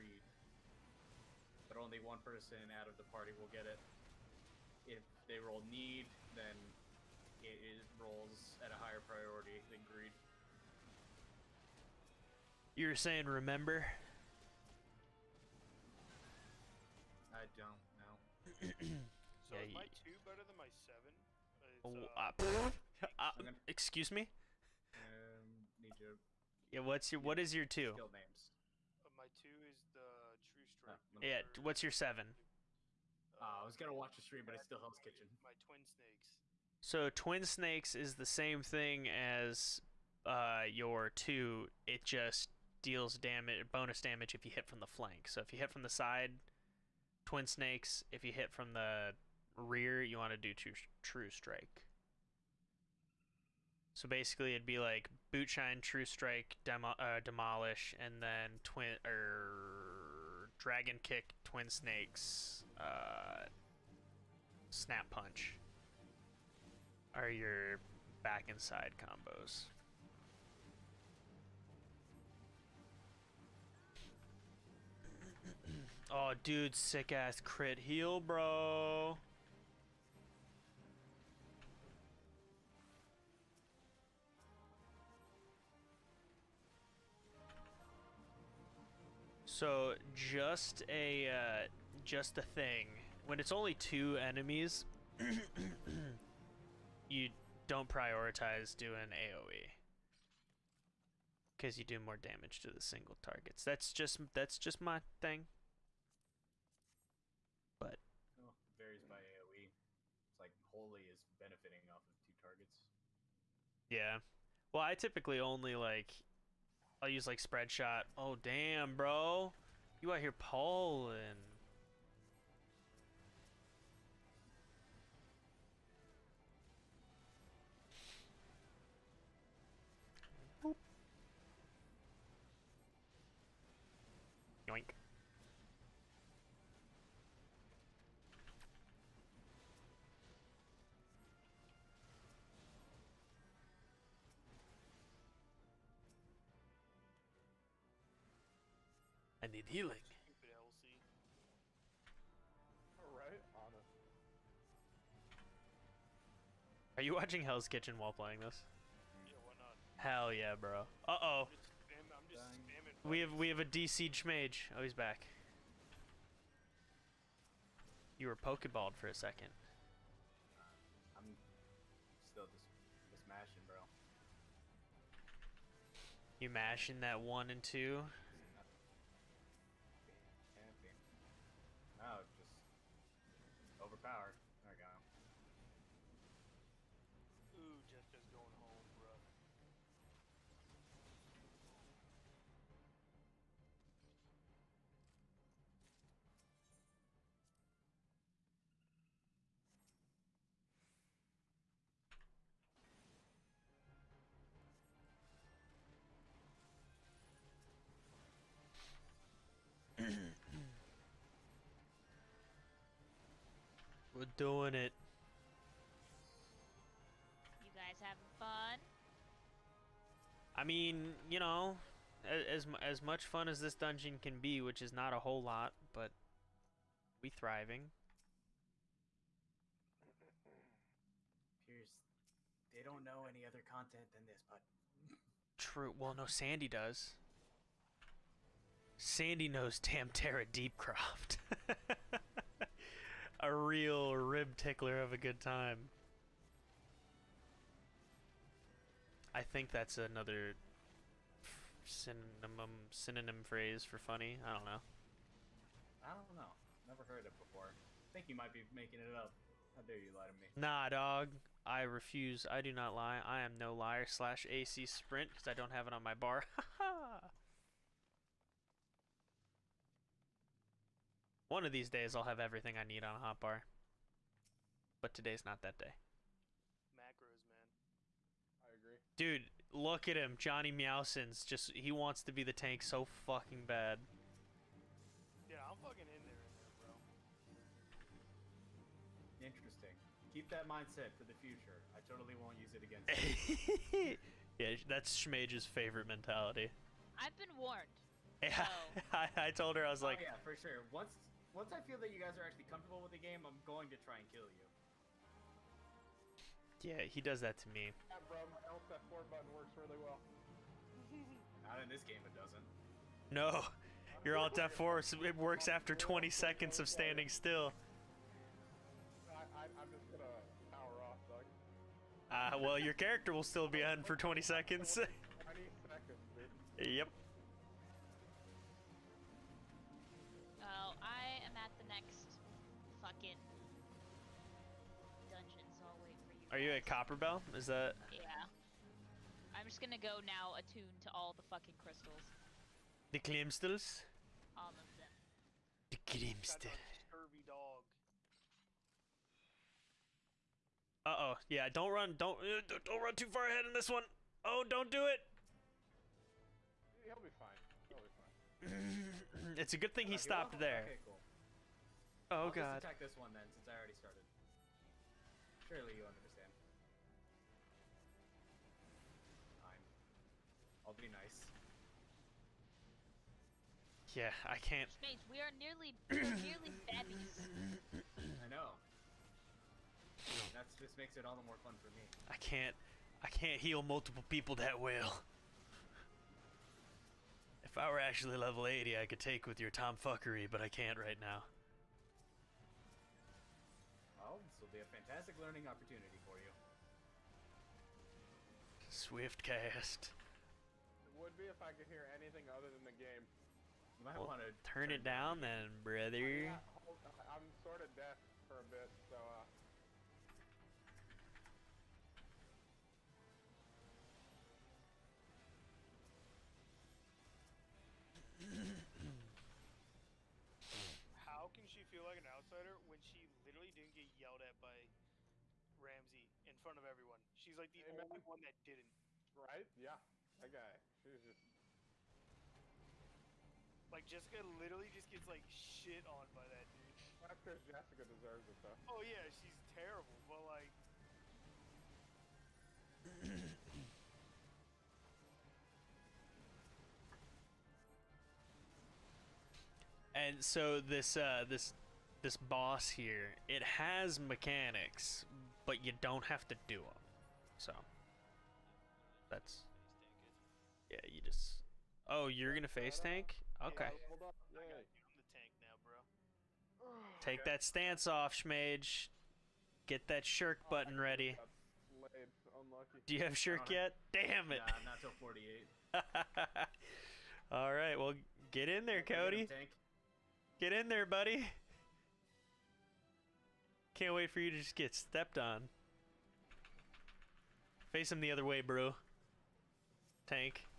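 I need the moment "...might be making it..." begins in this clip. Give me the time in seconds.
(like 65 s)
258 s.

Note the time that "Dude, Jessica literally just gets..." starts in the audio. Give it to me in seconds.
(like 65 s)
434 s.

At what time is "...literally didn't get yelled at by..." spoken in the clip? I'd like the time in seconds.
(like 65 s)
423 s.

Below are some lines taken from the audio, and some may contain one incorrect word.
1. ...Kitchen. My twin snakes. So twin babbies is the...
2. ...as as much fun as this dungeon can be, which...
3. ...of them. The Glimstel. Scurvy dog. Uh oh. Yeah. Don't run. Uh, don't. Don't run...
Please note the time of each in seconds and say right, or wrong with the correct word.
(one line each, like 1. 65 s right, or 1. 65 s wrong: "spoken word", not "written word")
1. 35 s wrong: "snakes", not "babbies"
2. 222 s right
3. 344 s right.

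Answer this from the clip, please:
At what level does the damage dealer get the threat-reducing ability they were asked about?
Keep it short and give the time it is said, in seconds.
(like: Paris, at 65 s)
48, at 475 s.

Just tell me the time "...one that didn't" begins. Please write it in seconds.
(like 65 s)
428 s.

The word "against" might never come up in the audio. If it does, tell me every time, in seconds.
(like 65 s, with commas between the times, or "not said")
292 s.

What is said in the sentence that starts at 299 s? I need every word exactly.
I, I, told her I was oh, like, yeah, for sure.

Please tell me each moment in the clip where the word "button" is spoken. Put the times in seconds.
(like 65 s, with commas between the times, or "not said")
309 s, 470 s.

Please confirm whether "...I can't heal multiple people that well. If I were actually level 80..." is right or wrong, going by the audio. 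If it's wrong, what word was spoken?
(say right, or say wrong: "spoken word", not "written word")
right.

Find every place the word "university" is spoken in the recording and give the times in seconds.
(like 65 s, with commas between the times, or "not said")
not said.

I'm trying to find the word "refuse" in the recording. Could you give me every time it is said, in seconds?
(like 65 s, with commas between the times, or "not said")
261 s.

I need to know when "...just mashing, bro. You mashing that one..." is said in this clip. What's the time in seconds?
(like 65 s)
173 s.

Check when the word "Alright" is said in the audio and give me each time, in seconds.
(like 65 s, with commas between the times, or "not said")
152 s.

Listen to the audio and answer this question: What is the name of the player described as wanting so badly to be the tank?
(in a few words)
Johnny Meowson.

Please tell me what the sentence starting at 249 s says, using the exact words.
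I think that's another synonym synonym phrase for funny.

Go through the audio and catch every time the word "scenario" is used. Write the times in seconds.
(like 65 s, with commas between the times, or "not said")
not said.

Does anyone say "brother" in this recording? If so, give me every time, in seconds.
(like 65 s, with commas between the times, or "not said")
405 s.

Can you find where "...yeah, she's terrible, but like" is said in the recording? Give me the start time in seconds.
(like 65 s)
439 s.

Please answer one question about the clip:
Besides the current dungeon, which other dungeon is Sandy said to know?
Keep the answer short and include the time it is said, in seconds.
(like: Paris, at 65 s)
Tam-Tara Deepcroft, at 239 s.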